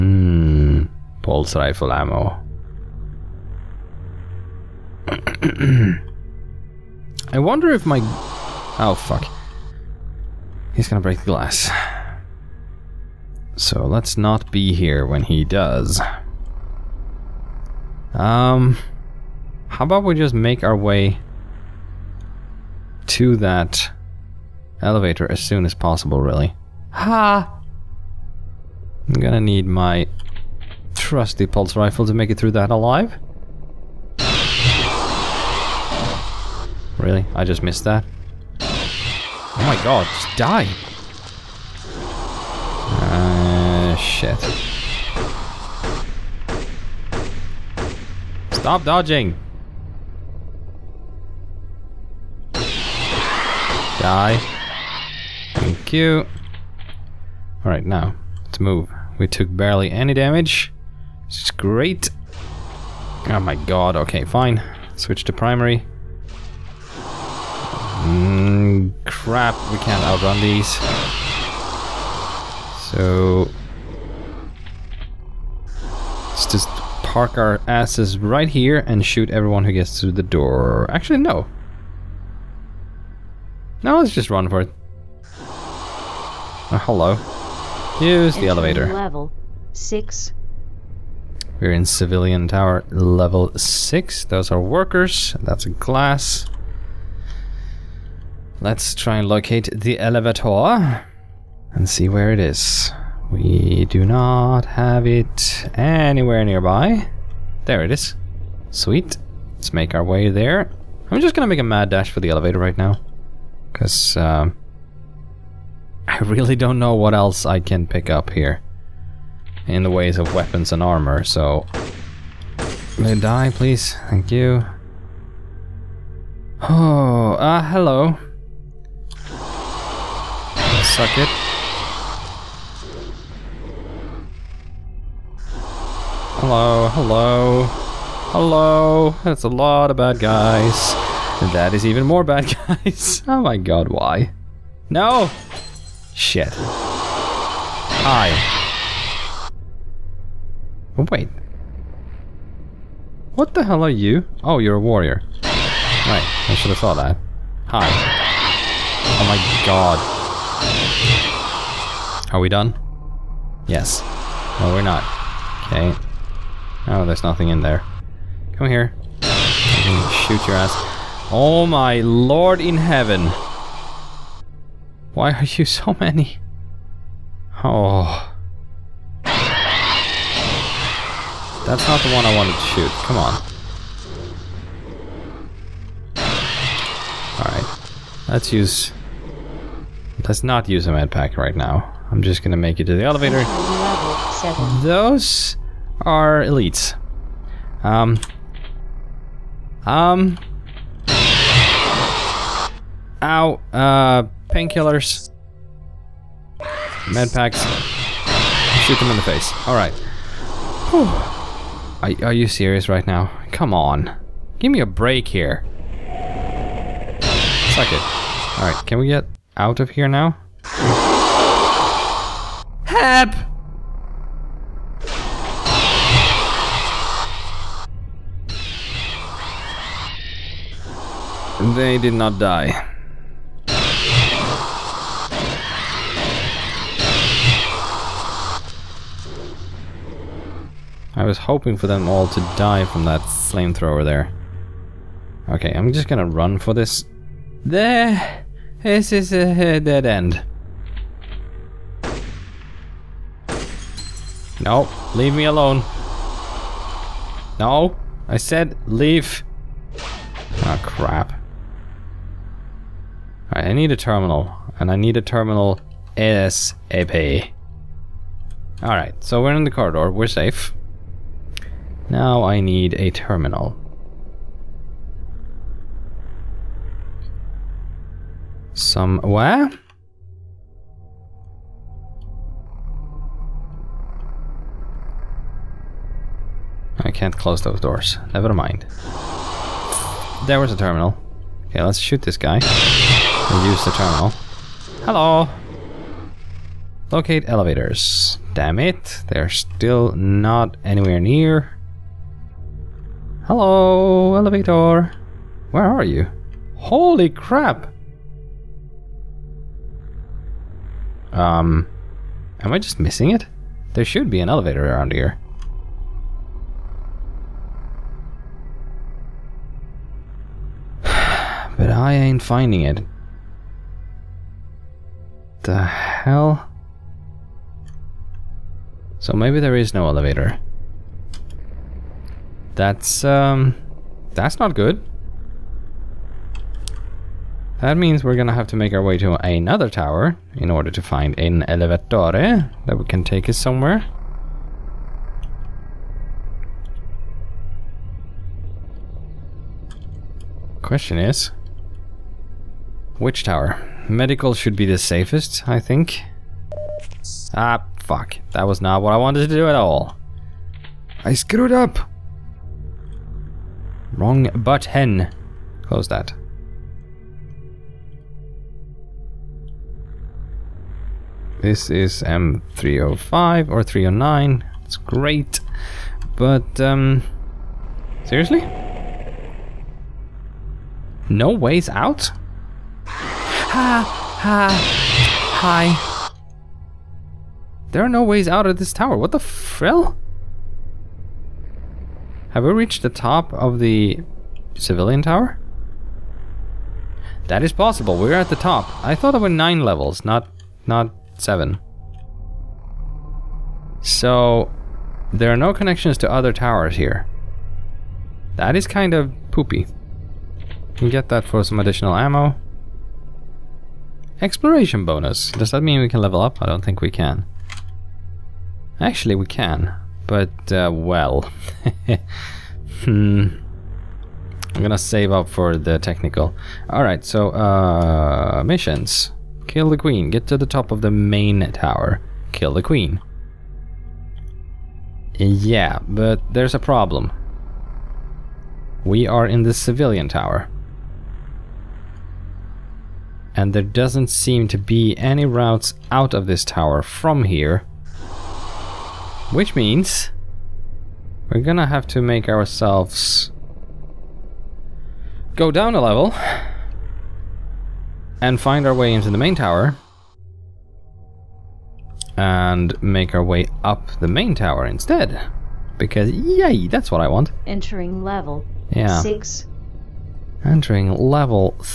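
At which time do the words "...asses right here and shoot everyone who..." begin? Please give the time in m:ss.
1:17.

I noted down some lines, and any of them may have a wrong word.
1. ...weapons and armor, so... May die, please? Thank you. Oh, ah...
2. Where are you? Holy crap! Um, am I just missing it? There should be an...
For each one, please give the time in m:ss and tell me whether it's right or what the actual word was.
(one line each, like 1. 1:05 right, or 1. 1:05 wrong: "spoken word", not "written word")
1. 2:00 right
2. 5:05 right.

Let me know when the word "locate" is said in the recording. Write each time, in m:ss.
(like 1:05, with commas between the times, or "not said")
1:39, 4:57.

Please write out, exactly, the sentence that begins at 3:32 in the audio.
Are, are you serious right now?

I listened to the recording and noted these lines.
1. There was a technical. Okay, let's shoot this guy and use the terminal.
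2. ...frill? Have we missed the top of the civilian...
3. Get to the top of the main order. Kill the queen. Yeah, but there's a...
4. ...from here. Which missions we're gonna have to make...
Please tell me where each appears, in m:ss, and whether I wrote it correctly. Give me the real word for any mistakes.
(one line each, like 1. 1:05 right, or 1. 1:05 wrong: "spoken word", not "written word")
1. 4:50 wrong: "terminal", not "technical"
2. 6:29 wrong: "reached", not "missed"
3. 7:10 wrong: "tower", not "order"
4. 7:27 wrong: "means", not "missions".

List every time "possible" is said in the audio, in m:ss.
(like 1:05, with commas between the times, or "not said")
0:25, 6:37.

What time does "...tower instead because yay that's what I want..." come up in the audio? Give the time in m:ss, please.
7:44.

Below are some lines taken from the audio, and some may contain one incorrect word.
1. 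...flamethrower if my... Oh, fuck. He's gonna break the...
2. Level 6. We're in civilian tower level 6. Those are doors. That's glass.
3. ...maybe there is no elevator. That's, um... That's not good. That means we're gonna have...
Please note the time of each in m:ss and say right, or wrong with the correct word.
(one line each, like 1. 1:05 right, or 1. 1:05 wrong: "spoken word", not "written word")
1. 0:07 wrong: "wonder", not "flamethrower"
2. 1:28 wrong: "workers", not "doors"
3. 5:29 right.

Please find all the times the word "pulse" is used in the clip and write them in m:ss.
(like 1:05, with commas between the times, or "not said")
0:01, 0:31.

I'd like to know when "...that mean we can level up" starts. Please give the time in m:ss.
6:55.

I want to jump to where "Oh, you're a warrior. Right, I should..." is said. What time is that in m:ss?
2:34.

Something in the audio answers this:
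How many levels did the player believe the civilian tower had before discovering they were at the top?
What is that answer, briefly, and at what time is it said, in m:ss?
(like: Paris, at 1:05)
9, at 6:39.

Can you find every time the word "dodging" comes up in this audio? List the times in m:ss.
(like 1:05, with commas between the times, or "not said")
0:48.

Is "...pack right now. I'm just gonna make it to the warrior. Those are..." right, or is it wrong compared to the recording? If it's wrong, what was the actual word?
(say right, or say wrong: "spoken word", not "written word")
wrong: "elevator", not "warrior".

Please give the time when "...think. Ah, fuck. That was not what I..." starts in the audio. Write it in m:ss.
5:55.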